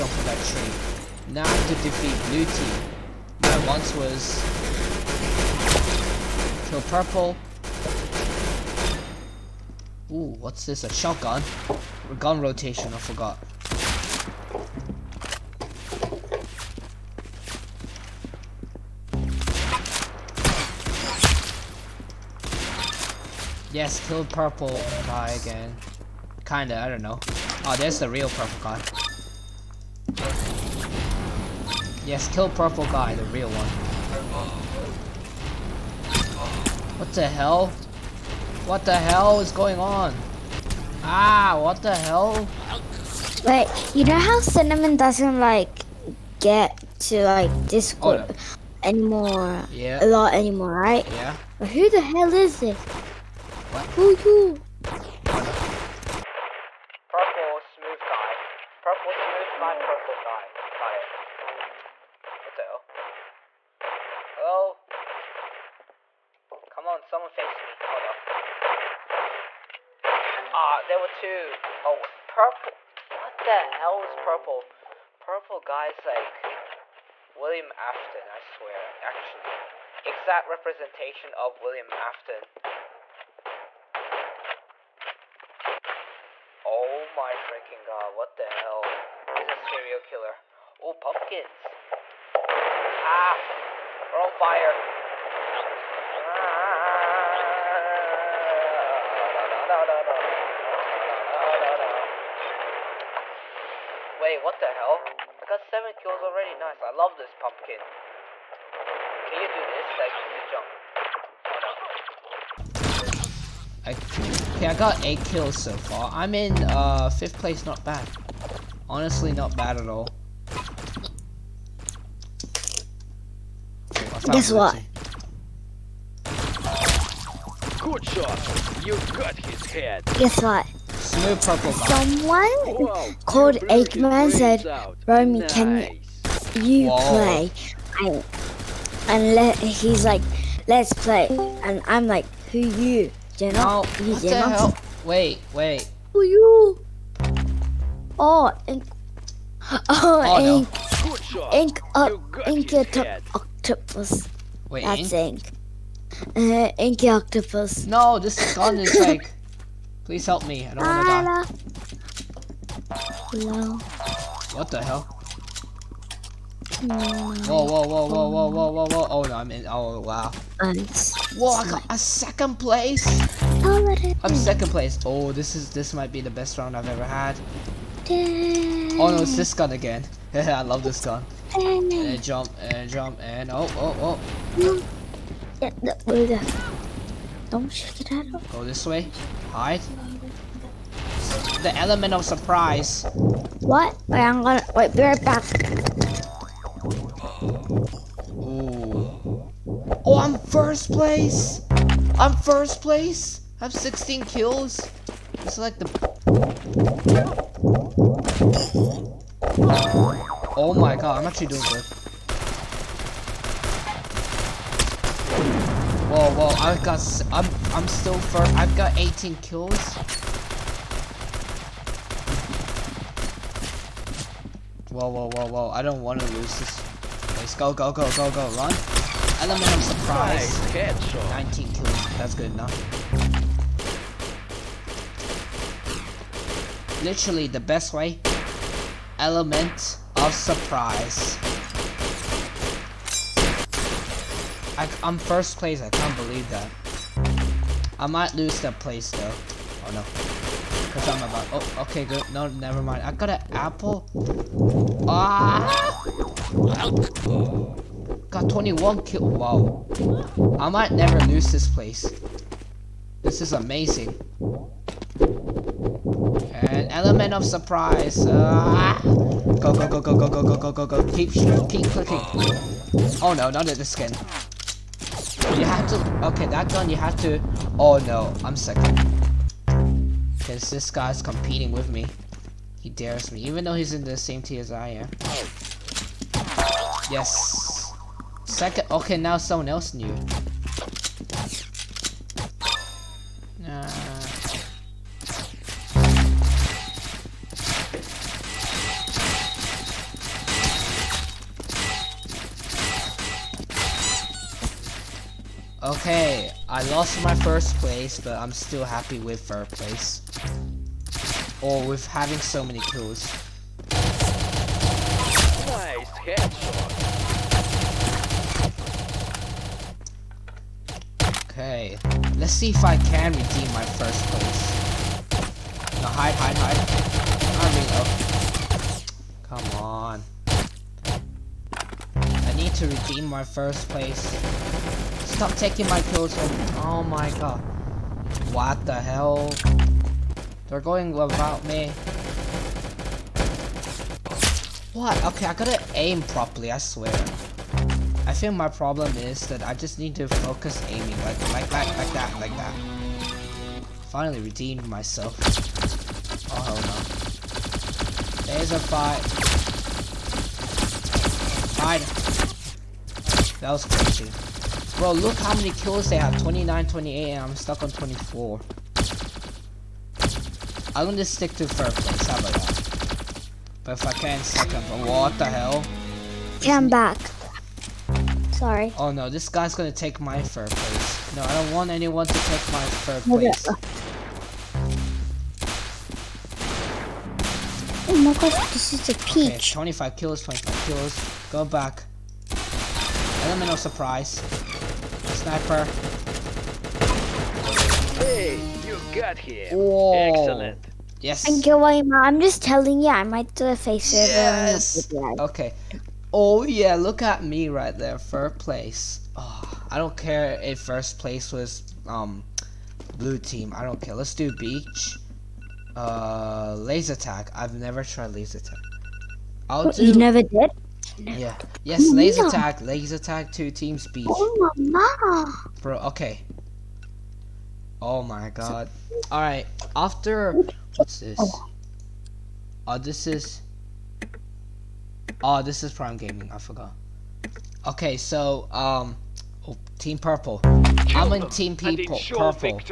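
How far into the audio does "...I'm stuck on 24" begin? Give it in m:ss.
6:07.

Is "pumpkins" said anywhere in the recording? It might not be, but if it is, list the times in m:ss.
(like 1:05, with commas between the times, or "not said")
1:30, 1:47.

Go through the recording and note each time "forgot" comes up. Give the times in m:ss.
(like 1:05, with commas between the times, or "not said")
0:12, 7:16.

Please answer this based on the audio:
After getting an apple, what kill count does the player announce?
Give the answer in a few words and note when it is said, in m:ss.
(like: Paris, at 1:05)
21, at 4:18.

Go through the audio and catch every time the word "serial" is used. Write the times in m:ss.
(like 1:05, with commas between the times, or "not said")
1:29.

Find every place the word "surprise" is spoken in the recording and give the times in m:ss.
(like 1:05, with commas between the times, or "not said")
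3:12, 3:49, 4:00, 4:27, 6:33.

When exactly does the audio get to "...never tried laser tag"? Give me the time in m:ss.
6:57.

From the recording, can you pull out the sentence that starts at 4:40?
Because this guy's competing with me.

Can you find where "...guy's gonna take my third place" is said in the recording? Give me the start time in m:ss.
6:19.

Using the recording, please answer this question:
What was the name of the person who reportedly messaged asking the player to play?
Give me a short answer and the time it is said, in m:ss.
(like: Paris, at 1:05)
Eggman, at 2:13.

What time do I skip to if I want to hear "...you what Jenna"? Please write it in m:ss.
2:23.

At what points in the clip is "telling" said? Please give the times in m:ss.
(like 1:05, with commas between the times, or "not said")
6:42.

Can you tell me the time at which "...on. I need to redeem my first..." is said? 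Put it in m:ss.
5:29.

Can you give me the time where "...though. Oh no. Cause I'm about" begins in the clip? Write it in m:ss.
4:09.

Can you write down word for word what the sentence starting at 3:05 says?
Yeah, Don't shake it at all.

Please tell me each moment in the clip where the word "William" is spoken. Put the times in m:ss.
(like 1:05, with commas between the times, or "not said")
1:17, 1:21.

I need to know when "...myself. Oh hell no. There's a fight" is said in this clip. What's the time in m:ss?
5:54.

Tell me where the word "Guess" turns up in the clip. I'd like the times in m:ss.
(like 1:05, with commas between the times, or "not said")
2:04, 2:10.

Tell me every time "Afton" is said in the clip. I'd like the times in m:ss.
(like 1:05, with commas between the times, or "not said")
1:17, 1:21.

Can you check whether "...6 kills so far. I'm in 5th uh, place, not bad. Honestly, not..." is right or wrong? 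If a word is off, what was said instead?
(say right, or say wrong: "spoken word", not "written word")
wrong: "8", not "6".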